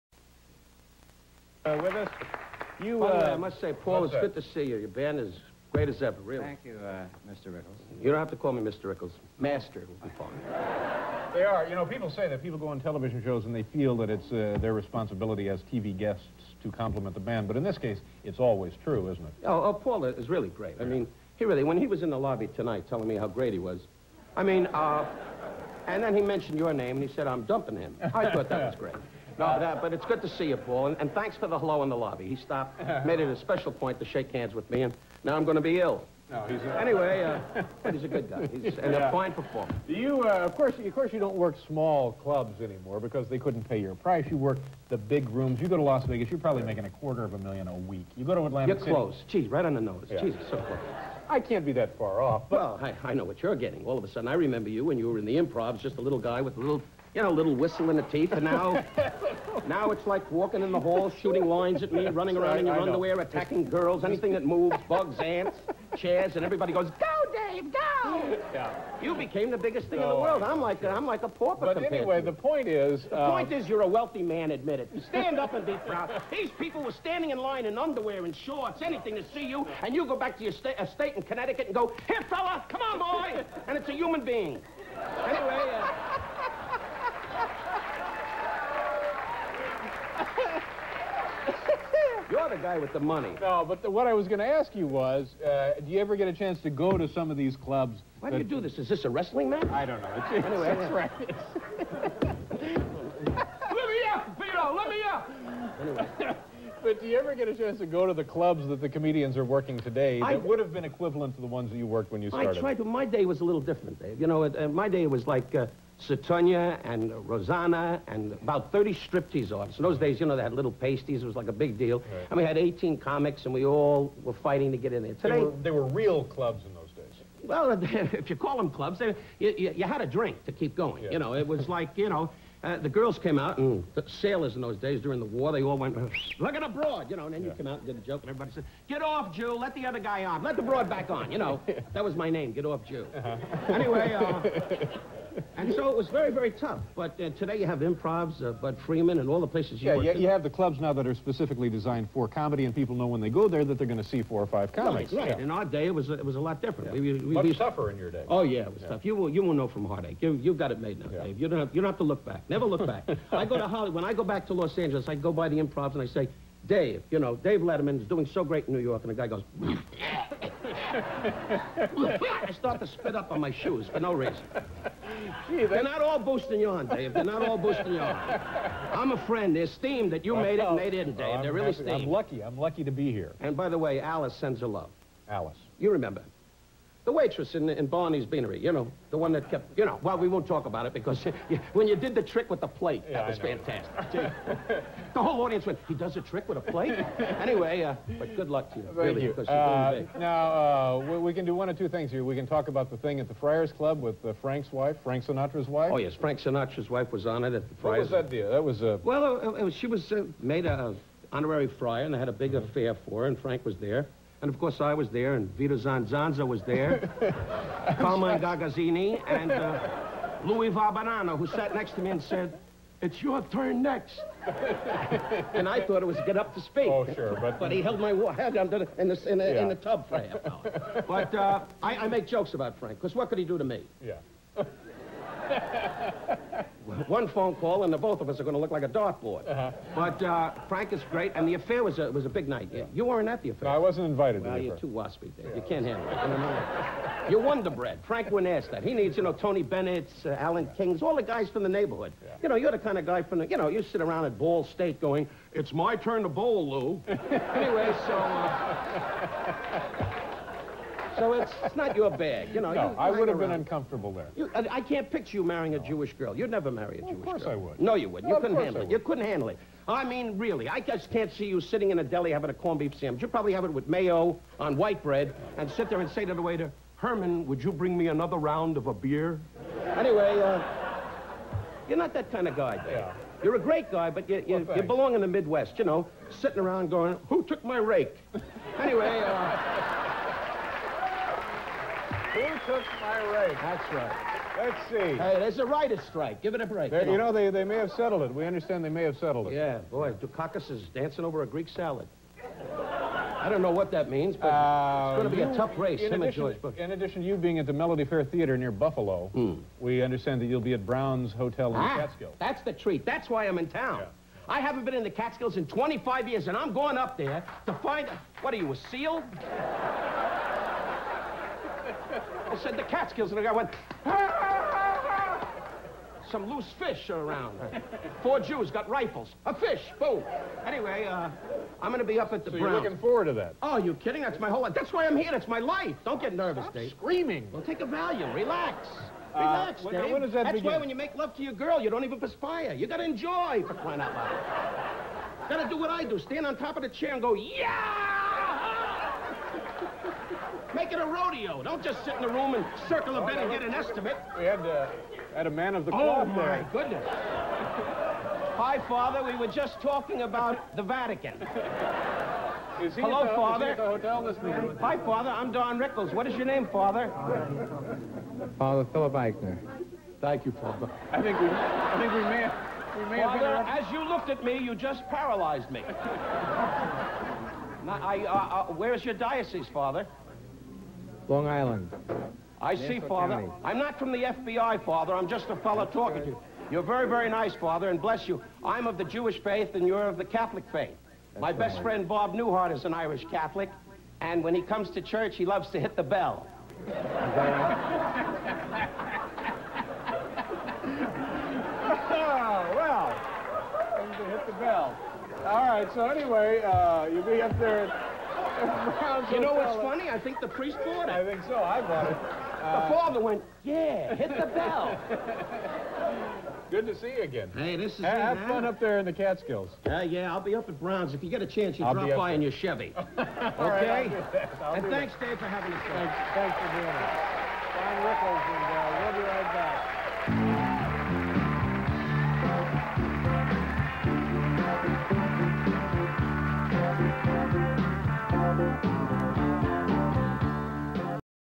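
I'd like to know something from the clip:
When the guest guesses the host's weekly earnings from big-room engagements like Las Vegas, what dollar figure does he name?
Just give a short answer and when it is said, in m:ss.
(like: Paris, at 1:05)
$250,000, at 0:46.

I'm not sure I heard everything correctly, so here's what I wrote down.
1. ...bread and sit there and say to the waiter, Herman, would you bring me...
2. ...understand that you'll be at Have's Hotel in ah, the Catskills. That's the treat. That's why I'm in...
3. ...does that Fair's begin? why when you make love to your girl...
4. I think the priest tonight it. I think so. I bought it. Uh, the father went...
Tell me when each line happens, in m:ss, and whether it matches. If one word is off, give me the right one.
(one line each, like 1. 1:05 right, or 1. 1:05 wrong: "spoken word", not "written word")
1. 4:35 right
2. 5:10 wrong: "Brown", not "Have"
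3. 5:40 wrong: "That", not "Fair"
4. 6:50 wrong: "bought", not "tonight".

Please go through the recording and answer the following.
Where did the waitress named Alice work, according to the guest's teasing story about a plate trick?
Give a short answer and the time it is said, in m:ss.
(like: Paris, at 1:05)
Barney's Beanery, at 3:07.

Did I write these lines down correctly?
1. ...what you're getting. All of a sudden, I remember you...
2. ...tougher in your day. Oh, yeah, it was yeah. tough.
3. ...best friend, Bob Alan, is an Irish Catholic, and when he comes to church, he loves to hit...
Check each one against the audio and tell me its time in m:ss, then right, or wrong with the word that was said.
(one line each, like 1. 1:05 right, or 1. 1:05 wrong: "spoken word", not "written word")
1. 0:53 right
2. 2:37 right
3. 6:31 wrong: "Newhart", not "Alan".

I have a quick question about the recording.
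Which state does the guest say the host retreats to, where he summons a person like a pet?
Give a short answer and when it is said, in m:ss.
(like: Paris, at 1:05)
Connecticut, at 1:21.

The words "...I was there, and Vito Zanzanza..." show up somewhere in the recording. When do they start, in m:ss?
3:34.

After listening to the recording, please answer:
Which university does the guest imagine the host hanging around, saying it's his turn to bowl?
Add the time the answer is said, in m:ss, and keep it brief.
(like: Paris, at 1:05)
Ball State, at 4:14.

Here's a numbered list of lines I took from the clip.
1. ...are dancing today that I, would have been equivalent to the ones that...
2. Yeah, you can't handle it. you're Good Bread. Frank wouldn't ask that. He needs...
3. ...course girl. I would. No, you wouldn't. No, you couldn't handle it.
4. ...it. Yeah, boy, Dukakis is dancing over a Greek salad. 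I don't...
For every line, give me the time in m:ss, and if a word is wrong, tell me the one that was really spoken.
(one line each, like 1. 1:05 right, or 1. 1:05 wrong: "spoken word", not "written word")
1. 1:49 wrong: "working", not "dancing"
2. 4:05 wrong: "Wonder", not "Good"
3. 4:27 right
4. 4:59 right.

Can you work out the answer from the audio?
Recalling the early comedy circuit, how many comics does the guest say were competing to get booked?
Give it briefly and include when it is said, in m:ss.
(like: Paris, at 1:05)
18, at 2:02.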